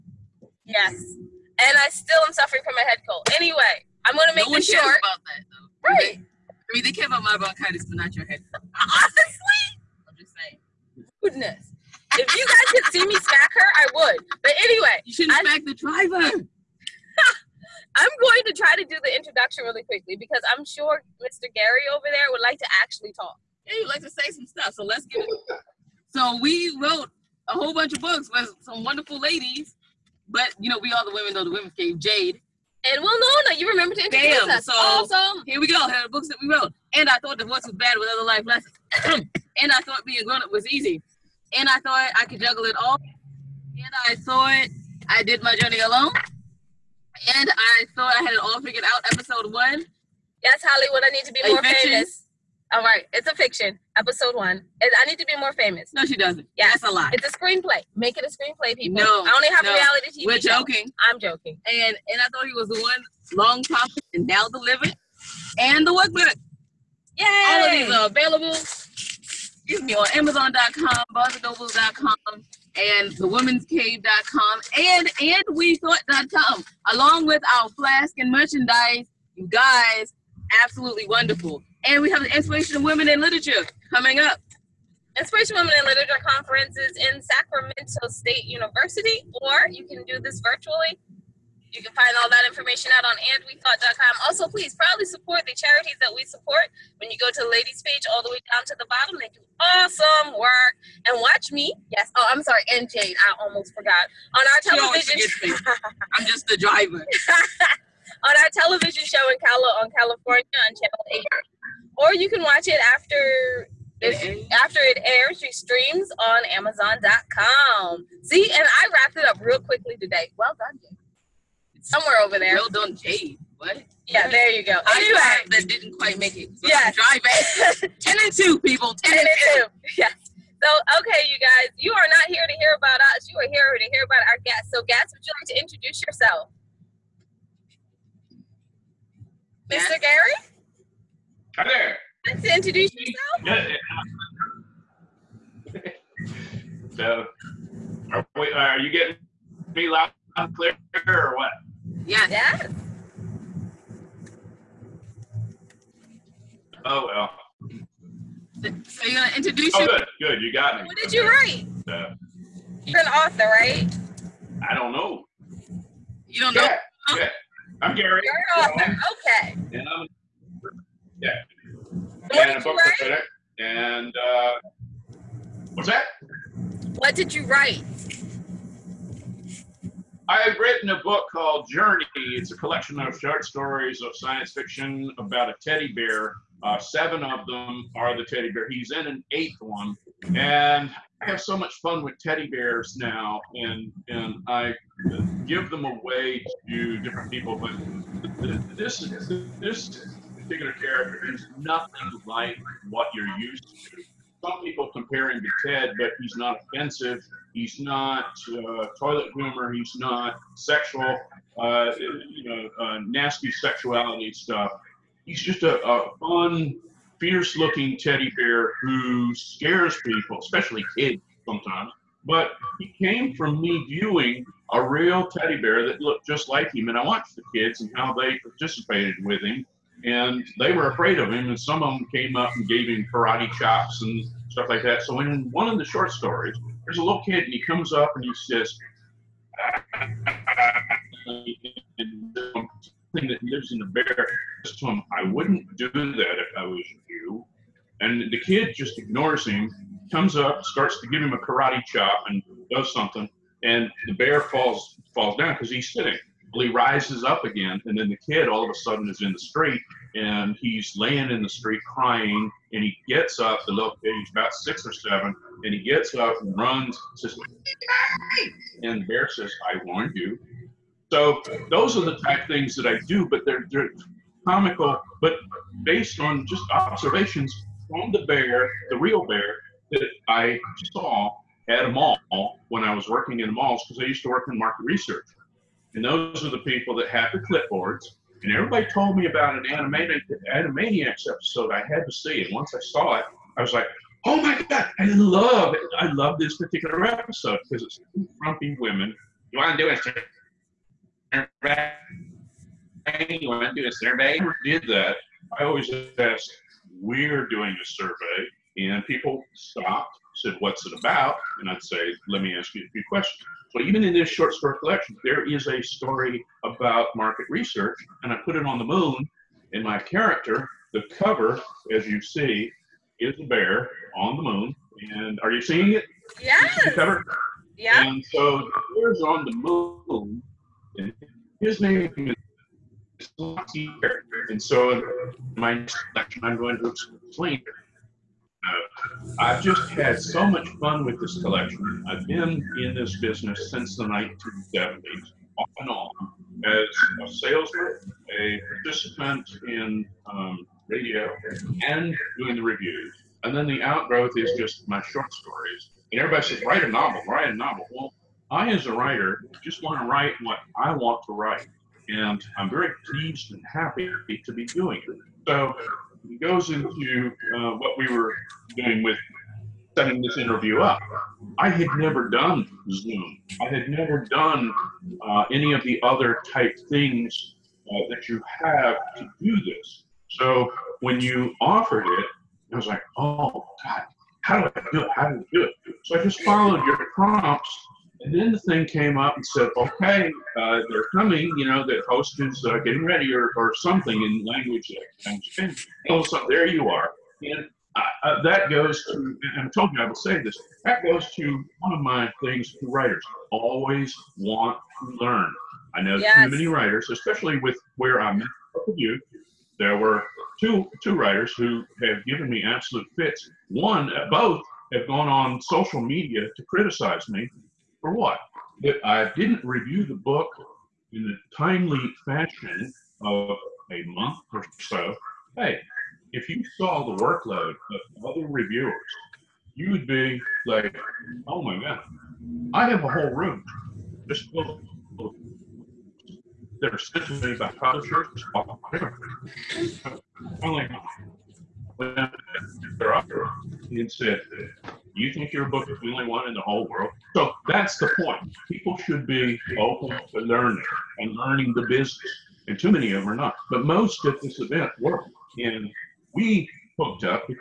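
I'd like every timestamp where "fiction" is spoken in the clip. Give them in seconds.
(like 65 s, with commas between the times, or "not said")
53 s, 184 s.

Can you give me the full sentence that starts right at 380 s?
So when you offered it, I was like, oh, God, how do I do it?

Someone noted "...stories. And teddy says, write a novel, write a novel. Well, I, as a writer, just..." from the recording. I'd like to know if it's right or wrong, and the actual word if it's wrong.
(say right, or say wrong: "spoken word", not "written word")
wrong: "everybody", not "teddy".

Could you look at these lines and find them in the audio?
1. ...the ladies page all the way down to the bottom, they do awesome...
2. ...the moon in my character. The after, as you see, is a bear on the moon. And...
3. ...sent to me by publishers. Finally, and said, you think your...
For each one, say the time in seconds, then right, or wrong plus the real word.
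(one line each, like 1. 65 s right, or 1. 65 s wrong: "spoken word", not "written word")
1. 97 s right
2. 318 s wrong: "cover", not "after"
3. 436 s right.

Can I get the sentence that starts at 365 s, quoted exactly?
So he goes into uh, what we were doing with setting this interview up.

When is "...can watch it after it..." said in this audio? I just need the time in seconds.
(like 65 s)
112 s.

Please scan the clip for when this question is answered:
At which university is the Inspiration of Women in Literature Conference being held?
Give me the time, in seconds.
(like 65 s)
87 s.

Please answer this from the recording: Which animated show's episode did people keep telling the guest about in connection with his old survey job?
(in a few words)
Animaniacs.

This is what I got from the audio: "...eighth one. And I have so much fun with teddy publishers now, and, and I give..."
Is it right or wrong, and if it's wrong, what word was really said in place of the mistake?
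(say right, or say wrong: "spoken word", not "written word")
wrong: "bears", not "publishers".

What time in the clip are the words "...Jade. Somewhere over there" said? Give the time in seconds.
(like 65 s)
120 s.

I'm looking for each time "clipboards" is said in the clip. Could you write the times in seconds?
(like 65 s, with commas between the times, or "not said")
287 s.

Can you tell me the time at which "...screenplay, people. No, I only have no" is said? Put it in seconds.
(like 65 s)
58 s.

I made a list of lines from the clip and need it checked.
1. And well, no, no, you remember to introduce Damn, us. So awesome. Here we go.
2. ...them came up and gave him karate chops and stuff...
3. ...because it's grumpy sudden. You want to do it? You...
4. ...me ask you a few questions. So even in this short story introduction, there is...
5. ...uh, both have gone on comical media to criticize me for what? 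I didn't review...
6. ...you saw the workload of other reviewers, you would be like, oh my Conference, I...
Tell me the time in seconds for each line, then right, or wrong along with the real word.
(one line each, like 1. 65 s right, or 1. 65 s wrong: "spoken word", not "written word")
1. 32 s right
2. 231 s right
3. 297 s wrong: "women", not "sudden"
4. 312 s wrong: "collection", not "introduction"
5. 414 s wrong: "social", not "comical"
6. 426 s wrong: "God", not "Conference".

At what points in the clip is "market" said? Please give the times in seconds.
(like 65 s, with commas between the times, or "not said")
284 s, 317 s.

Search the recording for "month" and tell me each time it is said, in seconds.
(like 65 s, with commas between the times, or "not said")
424 s.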